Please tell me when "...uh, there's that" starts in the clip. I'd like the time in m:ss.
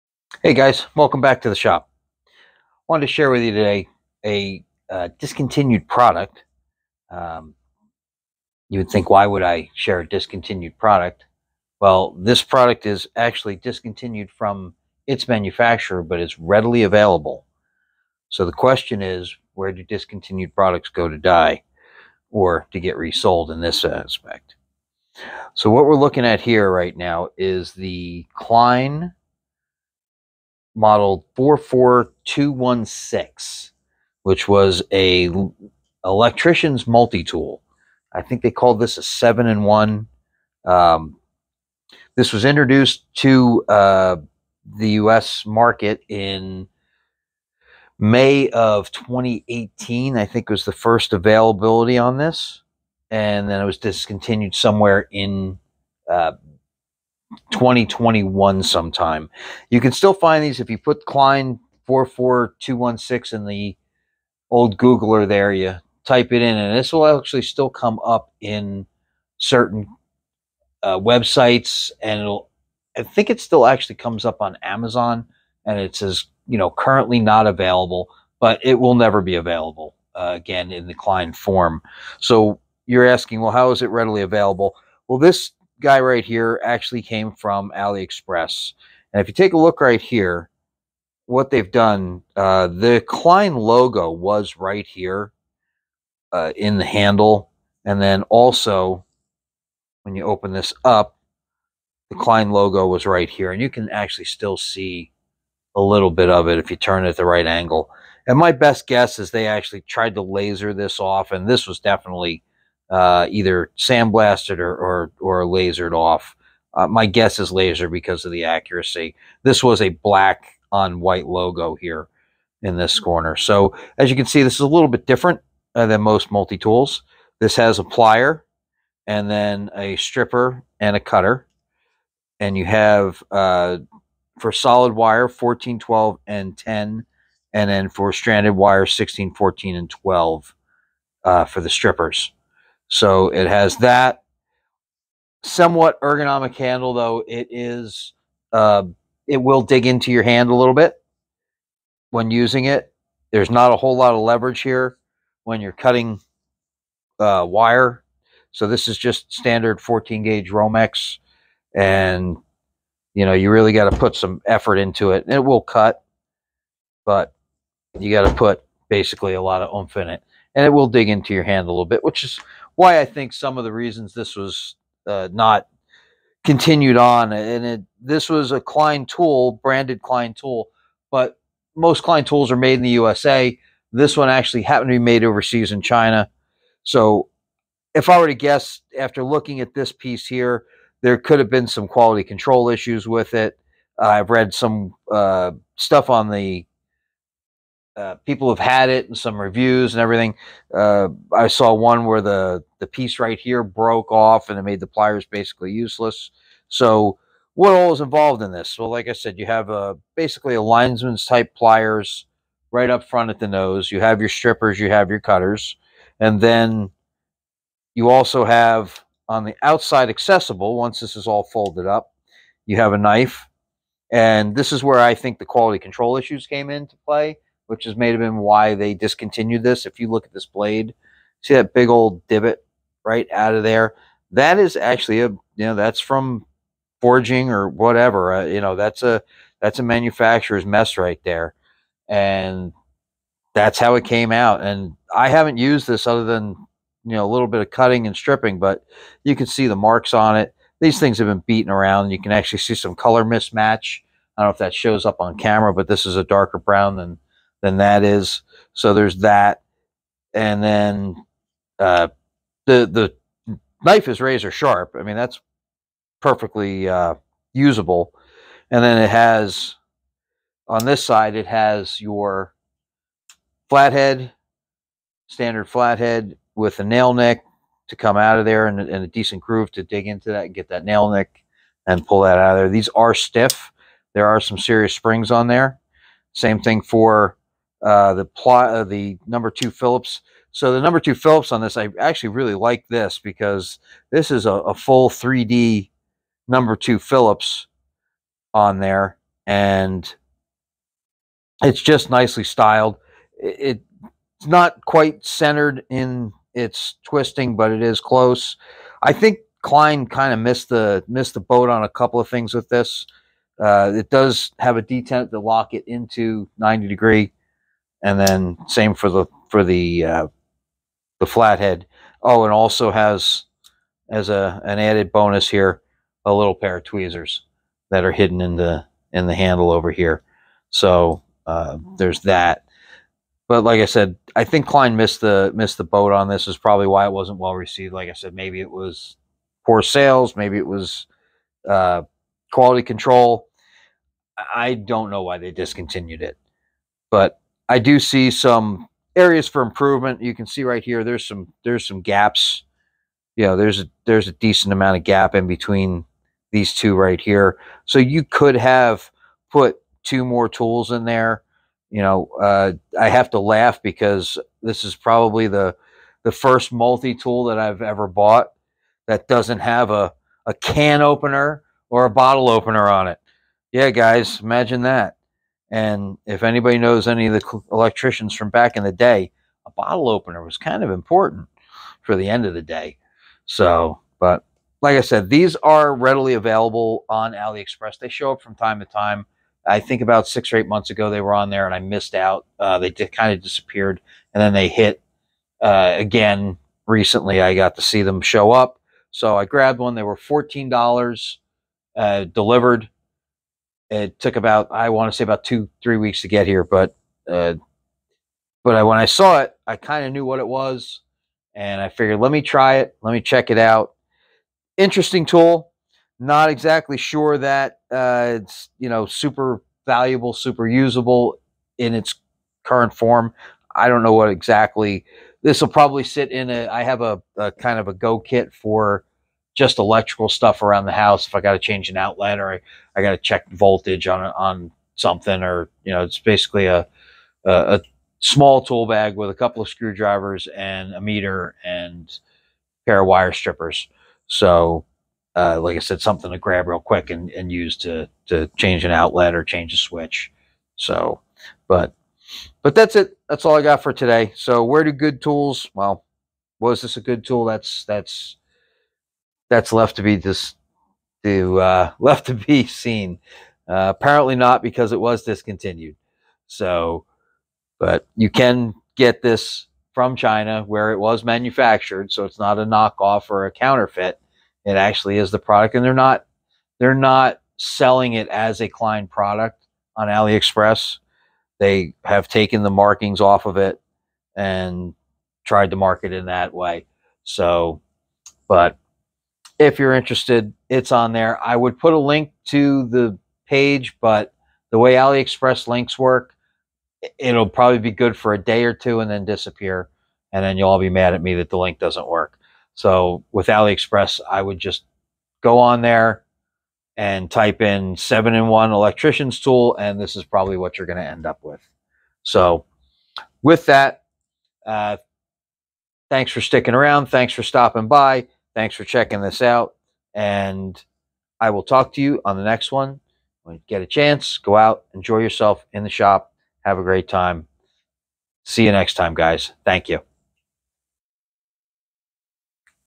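5:31.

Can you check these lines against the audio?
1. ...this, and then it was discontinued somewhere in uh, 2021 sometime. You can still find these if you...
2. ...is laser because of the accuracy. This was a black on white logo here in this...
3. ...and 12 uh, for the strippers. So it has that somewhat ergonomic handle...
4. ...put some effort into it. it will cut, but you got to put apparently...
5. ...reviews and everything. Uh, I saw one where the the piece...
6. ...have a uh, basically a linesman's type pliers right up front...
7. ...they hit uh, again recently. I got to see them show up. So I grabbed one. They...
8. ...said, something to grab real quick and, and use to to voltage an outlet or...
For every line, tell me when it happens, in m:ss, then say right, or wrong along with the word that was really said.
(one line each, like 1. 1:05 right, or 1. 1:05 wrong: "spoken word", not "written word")
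1. 0:52 right
2. 1:57 right
3. 2:19 right
4. 2:43 wrong: "basically", not "apparently"
5. 3:19 right
6. 3:29 right
7. 6:34 right
8. 7:25 wrong: "change", not "voltage".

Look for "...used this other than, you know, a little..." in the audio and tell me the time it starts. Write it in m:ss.
4:05.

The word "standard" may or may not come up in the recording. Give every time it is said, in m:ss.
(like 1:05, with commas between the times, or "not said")
2:39, 4:35.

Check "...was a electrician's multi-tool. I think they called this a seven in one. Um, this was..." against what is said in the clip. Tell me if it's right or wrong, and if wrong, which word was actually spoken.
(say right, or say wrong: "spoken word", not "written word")
right.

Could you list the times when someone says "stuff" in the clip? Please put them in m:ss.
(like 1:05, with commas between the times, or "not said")
3:15, 7:10.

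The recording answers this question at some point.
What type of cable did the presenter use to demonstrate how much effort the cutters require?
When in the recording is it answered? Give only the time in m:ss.
2:39.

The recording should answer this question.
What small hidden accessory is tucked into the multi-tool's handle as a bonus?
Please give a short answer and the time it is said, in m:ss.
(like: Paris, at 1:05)
tweezers, at 5:26.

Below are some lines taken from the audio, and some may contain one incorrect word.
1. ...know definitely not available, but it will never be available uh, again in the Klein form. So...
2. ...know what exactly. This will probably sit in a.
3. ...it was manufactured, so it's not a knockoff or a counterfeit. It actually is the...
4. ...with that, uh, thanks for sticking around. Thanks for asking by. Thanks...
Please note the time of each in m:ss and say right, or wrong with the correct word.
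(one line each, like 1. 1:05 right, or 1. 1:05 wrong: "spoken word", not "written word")
1. 1:16 wrong: "currently", not "definitely"
2. 7:04 right
3. 7:50 right
4. 8:33 wrong: "stopping", not "asking".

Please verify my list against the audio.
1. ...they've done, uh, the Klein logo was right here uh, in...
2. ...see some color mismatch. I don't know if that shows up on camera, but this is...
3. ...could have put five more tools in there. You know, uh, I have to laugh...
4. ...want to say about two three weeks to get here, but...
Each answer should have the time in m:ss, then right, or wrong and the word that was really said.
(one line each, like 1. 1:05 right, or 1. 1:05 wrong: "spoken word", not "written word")
1. 1:31 right
2. 4:12 right
3. 5:58 wrong: "two", not "five"
4. 6:44 right.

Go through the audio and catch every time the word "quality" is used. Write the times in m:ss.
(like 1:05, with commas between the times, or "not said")
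3:11, 3:45, 5:42.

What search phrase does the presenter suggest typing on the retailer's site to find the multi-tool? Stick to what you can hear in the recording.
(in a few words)
7 in 1 electrician's tool.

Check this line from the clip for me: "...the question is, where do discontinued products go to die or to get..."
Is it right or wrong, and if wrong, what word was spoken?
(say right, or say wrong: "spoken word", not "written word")
right.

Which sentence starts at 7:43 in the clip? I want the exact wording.
Uh, apparently not because it was discontinued.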